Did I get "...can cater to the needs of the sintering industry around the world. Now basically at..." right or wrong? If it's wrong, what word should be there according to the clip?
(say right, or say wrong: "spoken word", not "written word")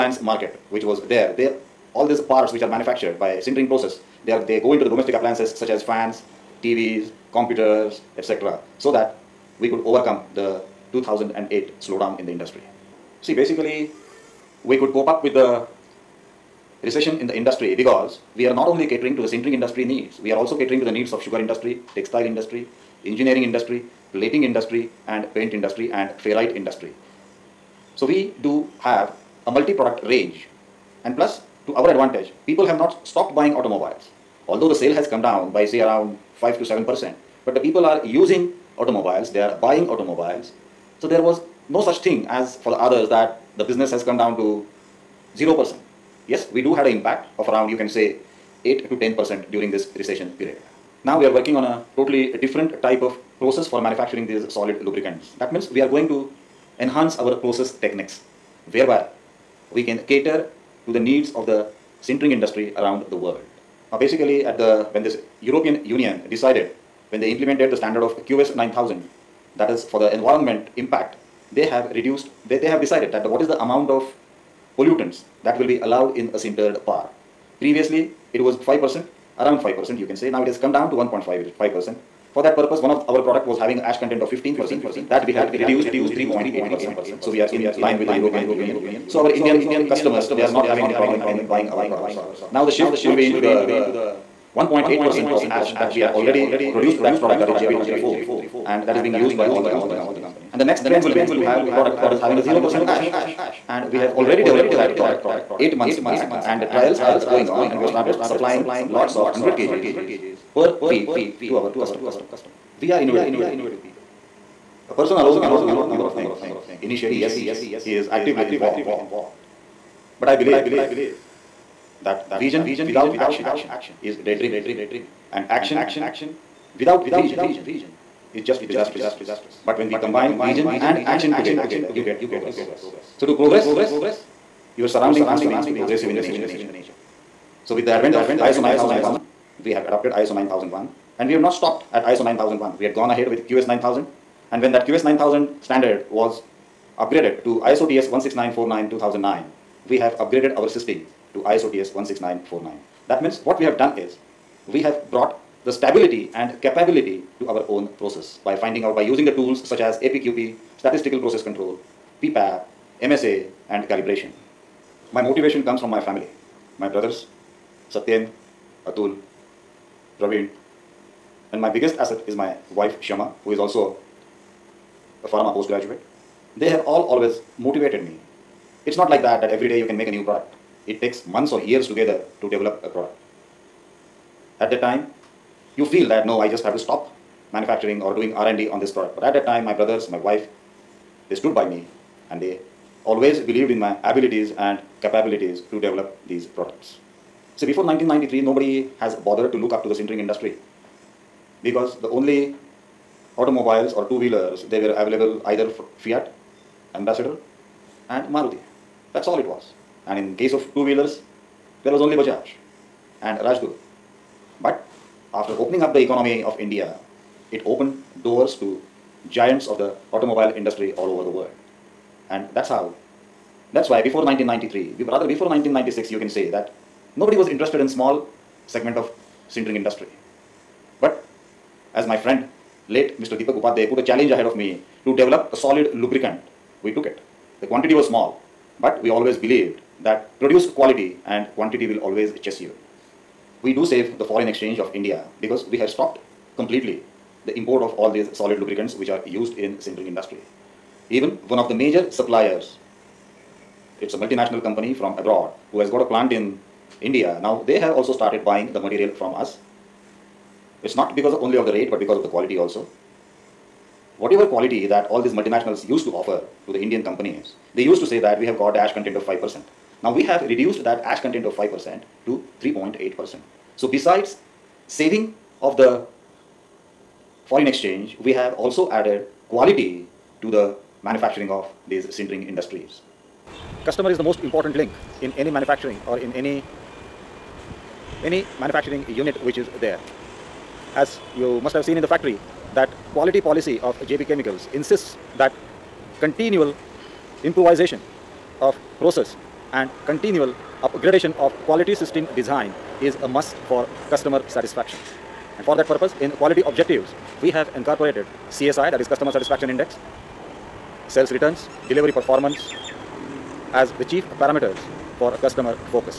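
right.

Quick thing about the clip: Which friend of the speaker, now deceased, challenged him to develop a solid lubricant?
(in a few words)
Deepak Upadhyay.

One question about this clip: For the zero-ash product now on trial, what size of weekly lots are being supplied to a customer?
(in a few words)
100 kgs.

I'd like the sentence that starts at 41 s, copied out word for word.
So there was no such thing as for the others that the business has come down to 0%.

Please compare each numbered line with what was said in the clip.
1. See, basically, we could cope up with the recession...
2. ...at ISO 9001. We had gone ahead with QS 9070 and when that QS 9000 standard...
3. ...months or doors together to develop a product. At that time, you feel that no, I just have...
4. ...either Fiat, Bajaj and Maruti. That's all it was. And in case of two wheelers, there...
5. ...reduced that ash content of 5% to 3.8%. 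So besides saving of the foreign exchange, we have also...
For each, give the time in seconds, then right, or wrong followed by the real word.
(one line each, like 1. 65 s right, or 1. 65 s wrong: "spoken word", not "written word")
1. 13 s right
2. 141 s wrong: "9000", not "9070"
3. 181 s wrong: "years", not "doors"
4. 205 s wrong: "Ambassador", not "Bajaj"
5. 270 s right.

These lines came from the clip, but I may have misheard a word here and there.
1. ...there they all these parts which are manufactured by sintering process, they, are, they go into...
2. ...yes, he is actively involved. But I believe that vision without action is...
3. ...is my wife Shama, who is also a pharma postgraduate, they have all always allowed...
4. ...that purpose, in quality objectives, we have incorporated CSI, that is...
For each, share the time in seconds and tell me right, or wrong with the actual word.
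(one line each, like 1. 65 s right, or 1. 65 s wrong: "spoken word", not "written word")
1. 1 s right
2. 117 s right
3. 172 s wrong: "motivated", not "allowed"
4. 305 s right.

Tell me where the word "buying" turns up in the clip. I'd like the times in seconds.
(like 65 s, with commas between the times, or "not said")
33 s, 39 s, 91 s, 258 s.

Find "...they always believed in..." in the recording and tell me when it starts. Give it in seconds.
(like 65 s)
192 s.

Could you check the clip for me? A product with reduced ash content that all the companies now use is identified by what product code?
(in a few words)
JB234.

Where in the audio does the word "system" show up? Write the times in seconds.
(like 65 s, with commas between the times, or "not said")
150 s, 301 s.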